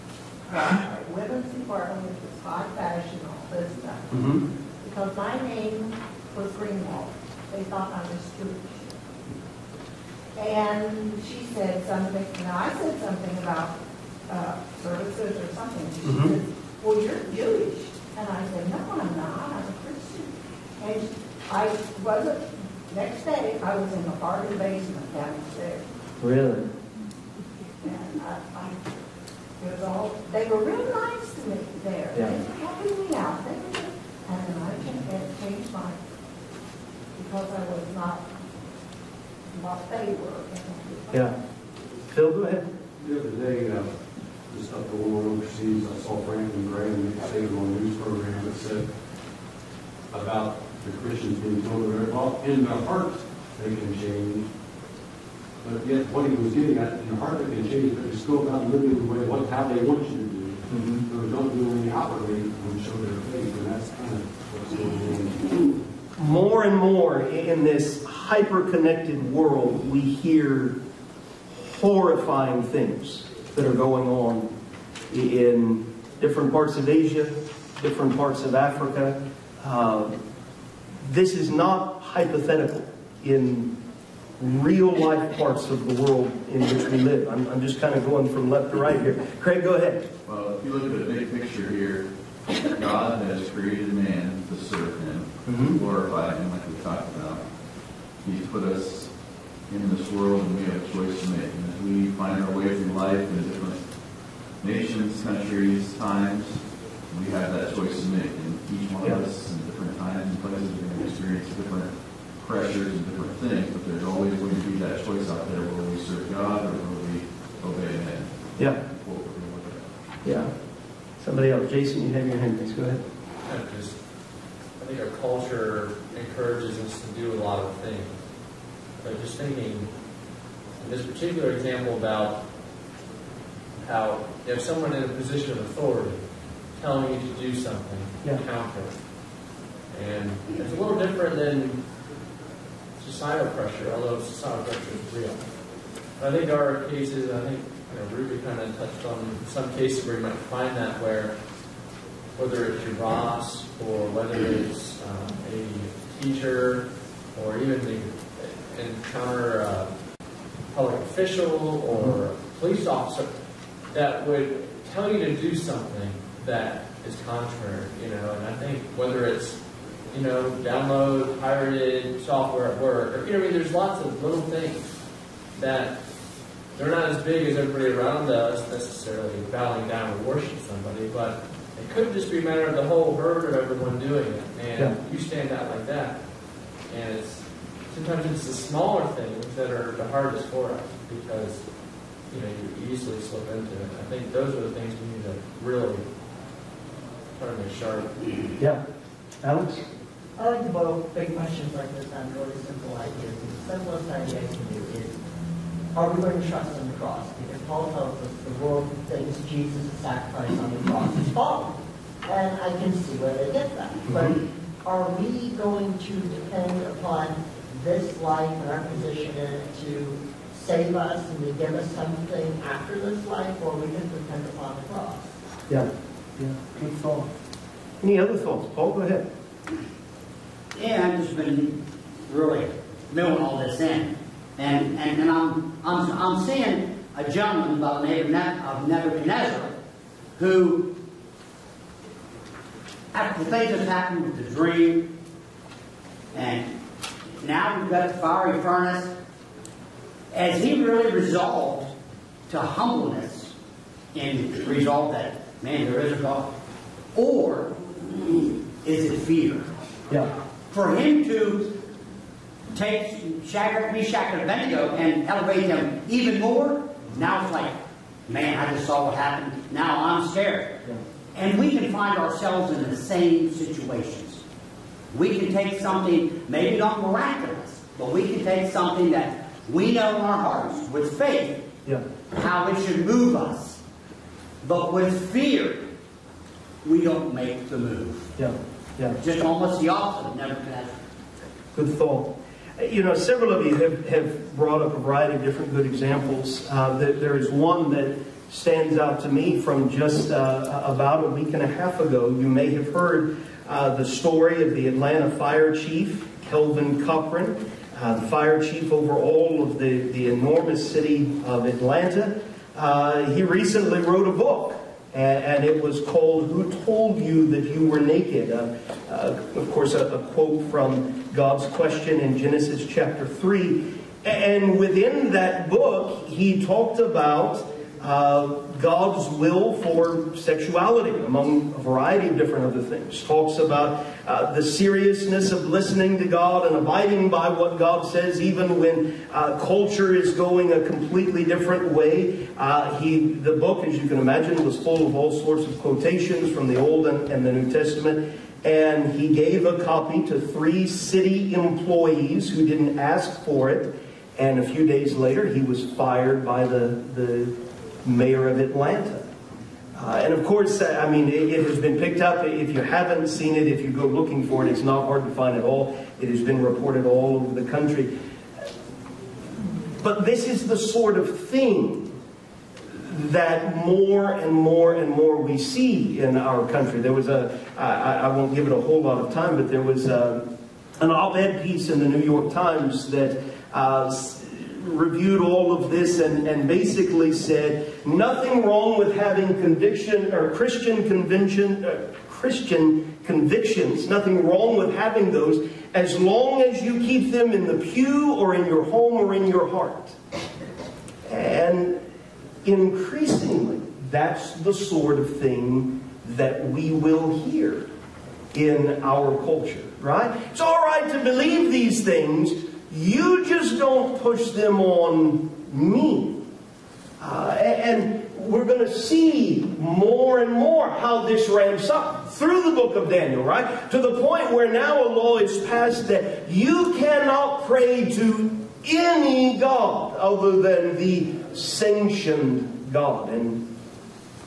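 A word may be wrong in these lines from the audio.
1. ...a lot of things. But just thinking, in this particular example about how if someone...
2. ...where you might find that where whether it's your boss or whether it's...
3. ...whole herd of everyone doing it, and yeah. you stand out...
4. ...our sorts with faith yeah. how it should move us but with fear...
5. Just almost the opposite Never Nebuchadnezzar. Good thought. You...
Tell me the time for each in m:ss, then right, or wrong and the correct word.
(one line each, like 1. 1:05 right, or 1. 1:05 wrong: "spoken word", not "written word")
1. 2:07 right
2. 2:30 right
3. 3:02 right
4. 4:40 wrong: "hearts", not "sorts"
5. 4:49 right.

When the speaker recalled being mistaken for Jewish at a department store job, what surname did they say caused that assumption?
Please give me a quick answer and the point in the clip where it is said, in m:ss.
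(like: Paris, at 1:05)
Greenwald, at 0:06.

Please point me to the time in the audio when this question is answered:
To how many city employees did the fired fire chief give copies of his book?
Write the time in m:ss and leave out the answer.
5:50.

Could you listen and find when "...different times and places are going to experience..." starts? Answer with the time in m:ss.
1:49.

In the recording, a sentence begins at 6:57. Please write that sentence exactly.
Uh, and we're going to see more and more how this ramps up through the book of Daniel, right?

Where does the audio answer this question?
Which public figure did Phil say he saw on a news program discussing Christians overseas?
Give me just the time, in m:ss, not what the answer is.
0:46.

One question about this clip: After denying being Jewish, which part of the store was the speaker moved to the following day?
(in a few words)
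garden basement.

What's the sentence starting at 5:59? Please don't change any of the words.
Uh, and of course, uh, I mean, it, it, has been picked up.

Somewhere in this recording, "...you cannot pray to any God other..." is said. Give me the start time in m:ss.
7:06.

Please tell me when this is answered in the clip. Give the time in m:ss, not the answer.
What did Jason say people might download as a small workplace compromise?
2:51.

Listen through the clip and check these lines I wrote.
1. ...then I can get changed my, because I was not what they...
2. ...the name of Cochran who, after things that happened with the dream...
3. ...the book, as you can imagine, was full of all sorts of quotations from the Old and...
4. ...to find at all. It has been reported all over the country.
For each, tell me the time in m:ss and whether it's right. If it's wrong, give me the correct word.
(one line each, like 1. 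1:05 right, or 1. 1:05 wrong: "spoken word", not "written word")
1. 0:34 right
2. 3:58 wrong: "Nebuchadnezzar", not "Cochran"
3. 5:43 right
4. 6:05 right.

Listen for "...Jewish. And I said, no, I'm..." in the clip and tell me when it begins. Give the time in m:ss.
0:17.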